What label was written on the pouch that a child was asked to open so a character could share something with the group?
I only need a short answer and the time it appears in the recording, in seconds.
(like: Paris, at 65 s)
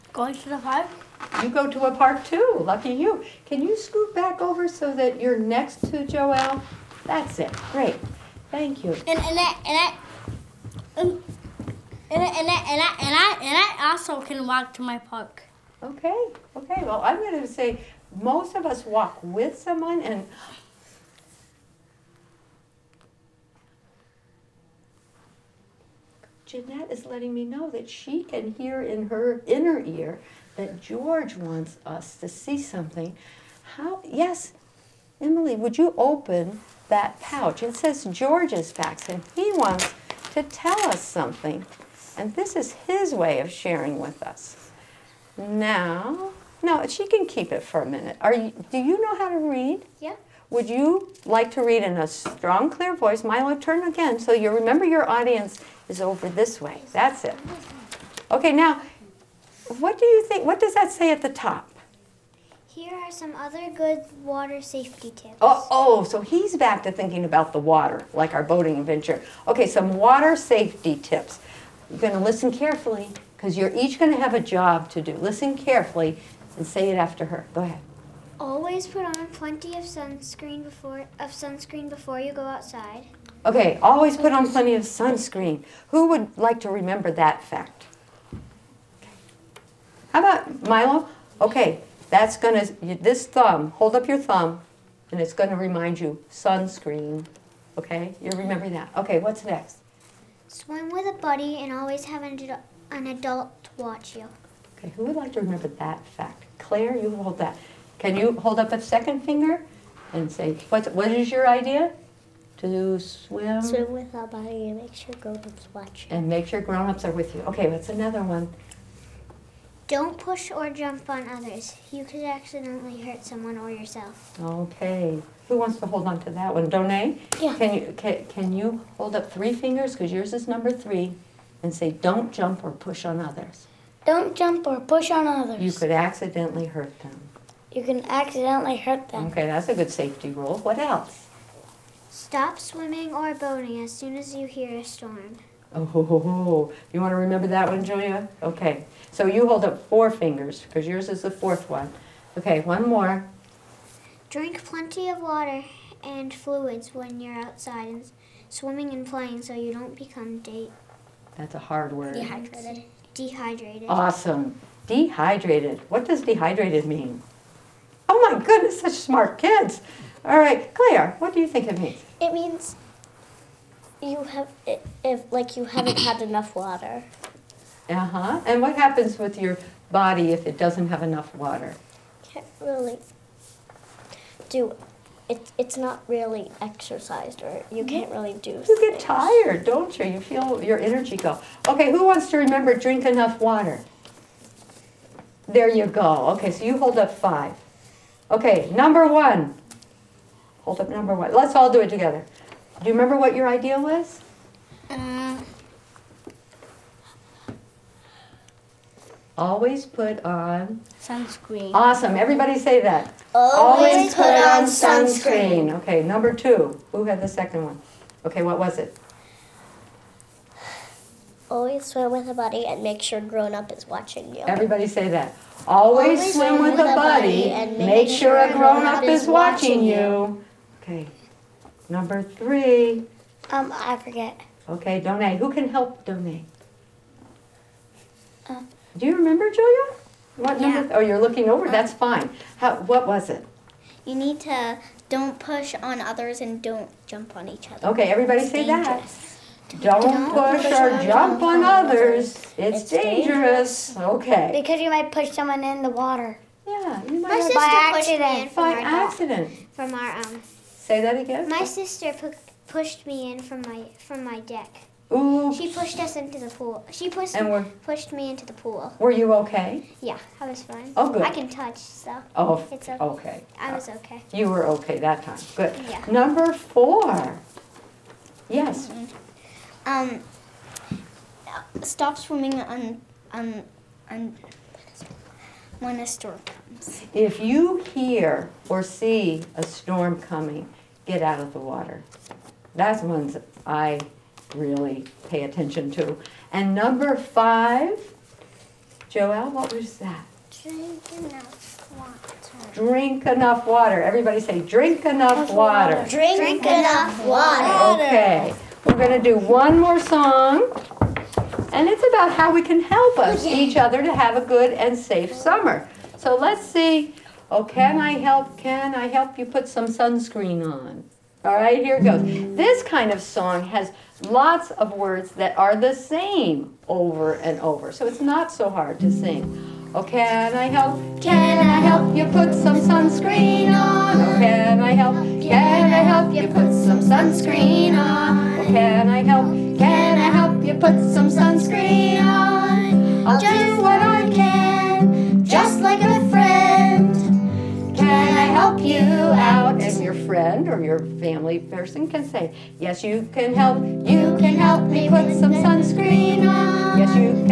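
George's facts, at 38 s.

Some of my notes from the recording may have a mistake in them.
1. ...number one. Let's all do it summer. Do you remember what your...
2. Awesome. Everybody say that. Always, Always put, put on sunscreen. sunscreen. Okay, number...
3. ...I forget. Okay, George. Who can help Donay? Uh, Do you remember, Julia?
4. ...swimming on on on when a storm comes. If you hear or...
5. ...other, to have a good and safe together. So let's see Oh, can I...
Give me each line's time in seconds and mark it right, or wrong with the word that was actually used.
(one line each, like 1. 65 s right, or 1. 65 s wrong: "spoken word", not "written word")
1. 200 s wrong: "together", not "summer"
2. 211 s right
3. 233 s wrong: "Donay", not "George"
4. 282 s right
5. 313 s wrong: "summer", not "together".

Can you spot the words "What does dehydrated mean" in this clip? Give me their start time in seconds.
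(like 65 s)
165 s.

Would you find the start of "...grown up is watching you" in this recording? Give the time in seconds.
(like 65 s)
223 s.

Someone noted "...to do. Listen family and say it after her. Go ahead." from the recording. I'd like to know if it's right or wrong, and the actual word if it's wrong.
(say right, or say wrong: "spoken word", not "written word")
wrong: "carefully", not "family".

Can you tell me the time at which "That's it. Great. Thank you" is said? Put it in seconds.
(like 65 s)
7 s.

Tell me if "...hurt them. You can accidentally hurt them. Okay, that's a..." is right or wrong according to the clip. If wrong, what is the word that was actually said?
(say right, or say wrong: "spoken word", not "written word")
right.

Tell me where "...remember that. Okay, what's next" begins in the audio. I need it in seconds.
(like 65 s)
98 s.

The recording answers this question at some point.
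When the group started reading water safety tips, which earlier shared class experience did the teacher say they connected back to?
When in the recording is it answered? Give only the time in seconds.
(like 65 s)
68 s.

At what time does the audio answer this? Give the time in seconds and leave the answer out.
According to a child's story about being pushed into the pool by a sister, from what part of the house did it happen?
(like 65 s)
264 s.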